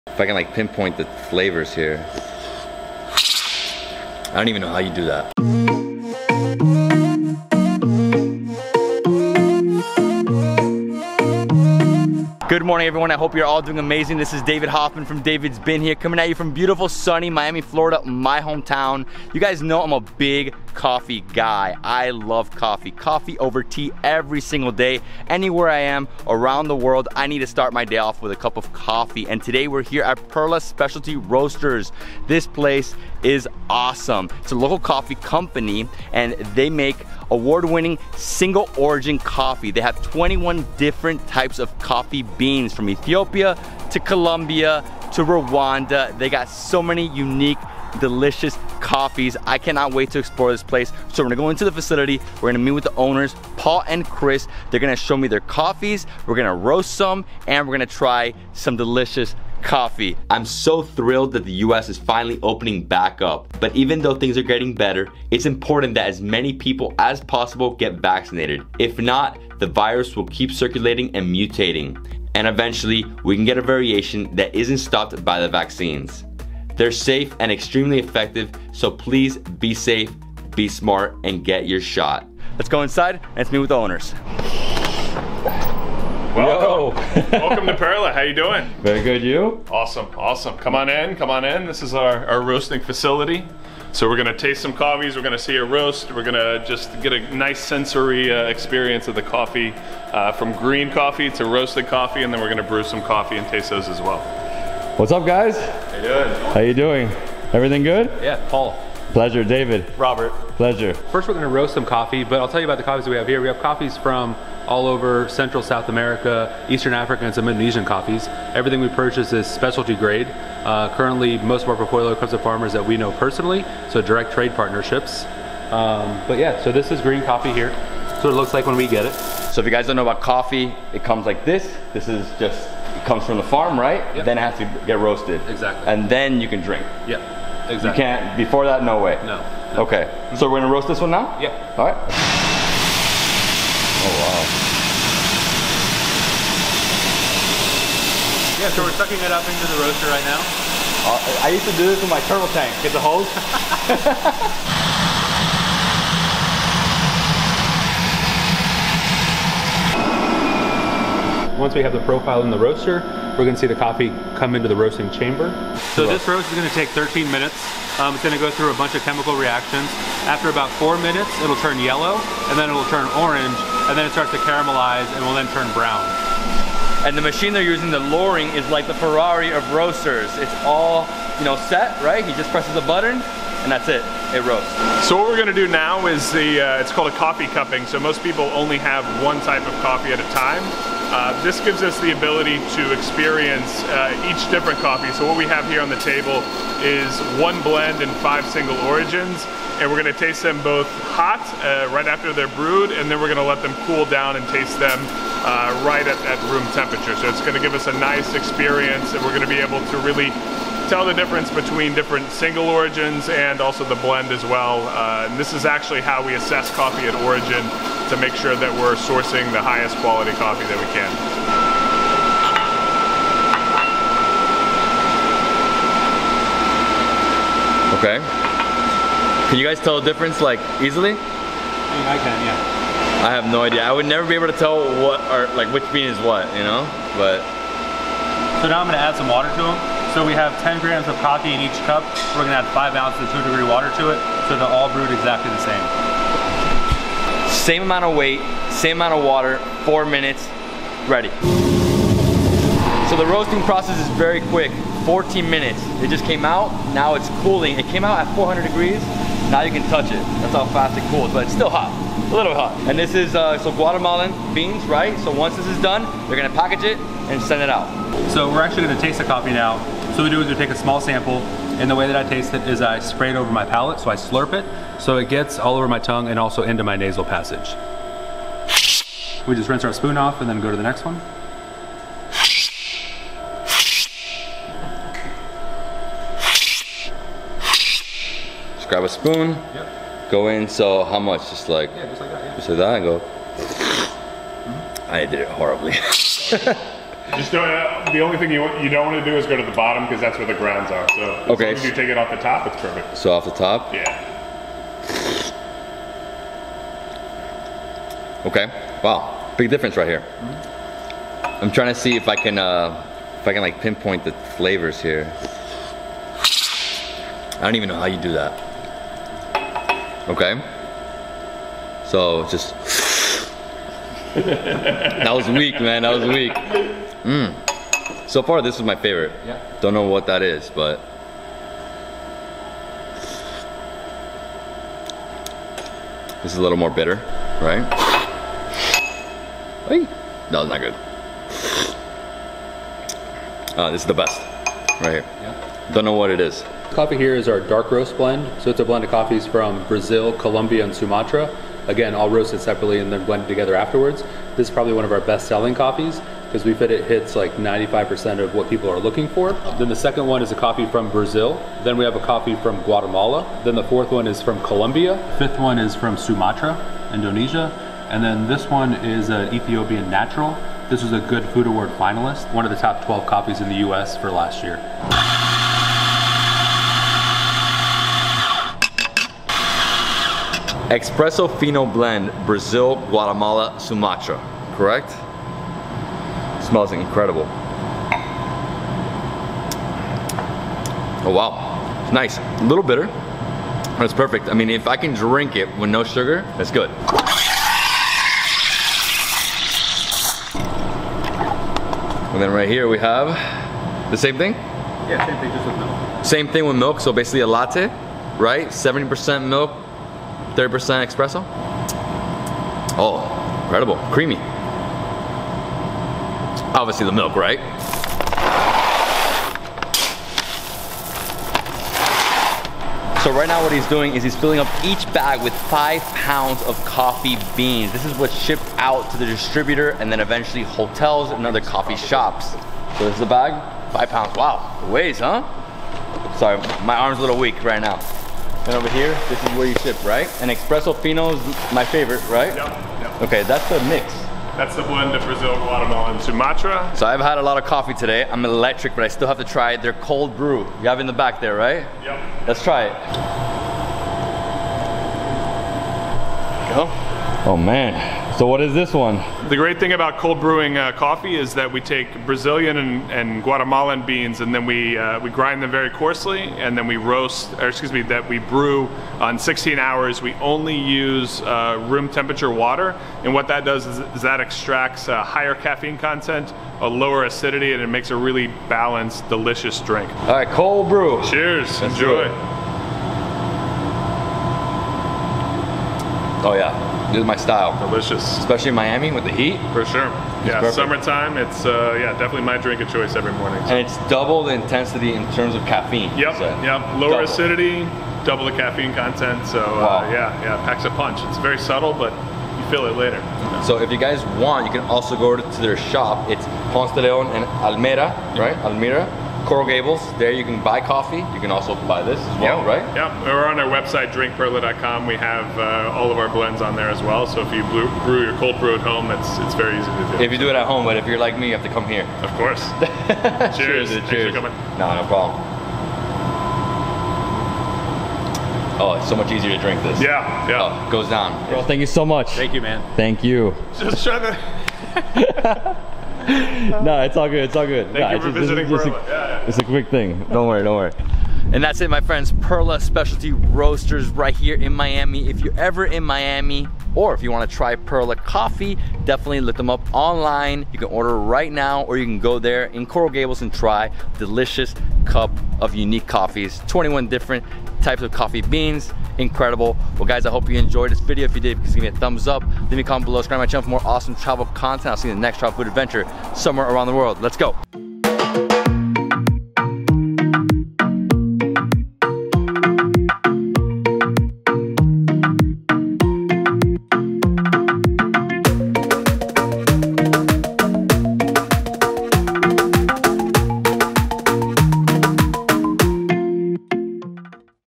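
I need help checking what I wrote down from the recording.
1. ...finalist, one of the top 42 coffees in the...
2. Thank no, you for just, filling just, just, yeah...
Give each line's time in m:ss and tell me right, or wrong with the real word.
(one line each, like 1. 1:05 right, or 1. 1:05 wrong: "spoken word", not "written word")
1. 6:11 wrong: "12", not "42"
2. 8:57 wrong: "visiting", not "filling".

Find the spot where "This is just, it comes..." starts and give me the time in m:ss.
2:11.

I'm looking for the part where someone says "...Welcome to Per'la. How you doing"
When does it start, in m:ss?
1:27.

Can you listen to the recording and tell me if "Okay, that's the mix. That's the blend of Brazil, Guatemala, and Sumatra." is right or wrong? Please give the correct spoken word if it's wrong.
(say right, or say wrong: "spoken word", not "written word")
right.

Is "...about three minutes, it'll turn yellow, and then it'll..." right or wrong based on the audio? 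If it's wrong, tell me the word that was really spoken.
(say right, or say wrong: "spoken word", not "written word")
wrong: "four", not "three".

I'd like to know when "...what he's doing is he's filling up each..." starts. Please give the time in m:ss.
7:03.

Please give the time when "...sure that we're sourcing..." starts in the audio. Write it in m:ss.
3:38.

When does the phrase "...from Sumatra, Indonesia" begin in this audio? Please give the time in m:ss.
6:05.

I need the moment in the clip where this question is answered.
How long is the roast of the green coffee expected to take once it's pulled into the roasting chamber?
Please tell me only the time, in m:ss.
2:46.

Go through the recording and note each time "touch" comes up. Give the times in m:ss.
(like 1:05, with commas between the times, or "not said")
4:19.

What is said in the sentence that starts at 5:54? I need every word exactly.
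This is probably one of our best selling coffees because we fit it hits like 95% of what people are looking for.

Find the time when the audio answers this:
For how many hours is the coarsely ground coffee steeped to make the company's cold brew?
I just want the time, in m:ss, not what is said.
7:49.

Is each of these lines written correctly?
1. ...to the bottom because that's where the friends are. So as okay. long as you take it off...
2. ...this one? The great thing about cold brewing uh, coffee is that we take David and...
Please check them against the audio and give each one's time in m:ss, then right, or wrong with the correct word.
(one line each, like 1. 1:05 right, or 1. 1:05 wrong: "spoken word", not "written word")
1. 4:59 wrong: "grounds", not "friends"
2. 7:38 wrong: "Brazilian", not "David".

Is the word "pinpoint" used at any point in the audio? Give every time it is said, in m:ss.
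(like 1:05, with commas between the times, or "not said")
0:00, 5:13.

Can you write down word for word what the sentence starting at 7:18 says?
And over here, this is where you ship, right?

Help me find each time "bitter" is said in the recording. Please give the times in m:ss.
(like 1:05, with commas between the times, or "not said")
5:36, 6:32.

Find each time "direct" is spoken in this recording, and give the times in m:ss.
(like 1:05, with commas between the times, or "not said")
2:04.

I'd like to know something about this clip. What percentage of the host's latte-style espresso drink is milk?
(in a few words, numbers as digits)
70%.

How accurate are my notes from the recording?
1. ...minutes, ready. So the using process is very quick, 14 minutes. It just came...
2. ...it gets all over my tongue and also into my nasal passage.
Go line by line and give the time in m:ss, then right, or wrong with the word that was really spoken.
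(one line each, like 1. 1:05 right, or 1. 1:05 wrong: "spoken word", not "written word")
1. 4:10 wrong: "roasting", not "using"
2. 4:35 right.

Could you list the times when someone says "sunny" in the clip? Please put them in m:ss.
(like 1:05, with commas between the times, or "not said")
0:16.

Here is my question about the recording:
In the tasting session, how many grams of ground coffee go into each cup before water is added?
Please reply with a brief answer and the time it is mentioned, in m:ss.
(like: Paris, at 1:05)
10 grams, at 4:00.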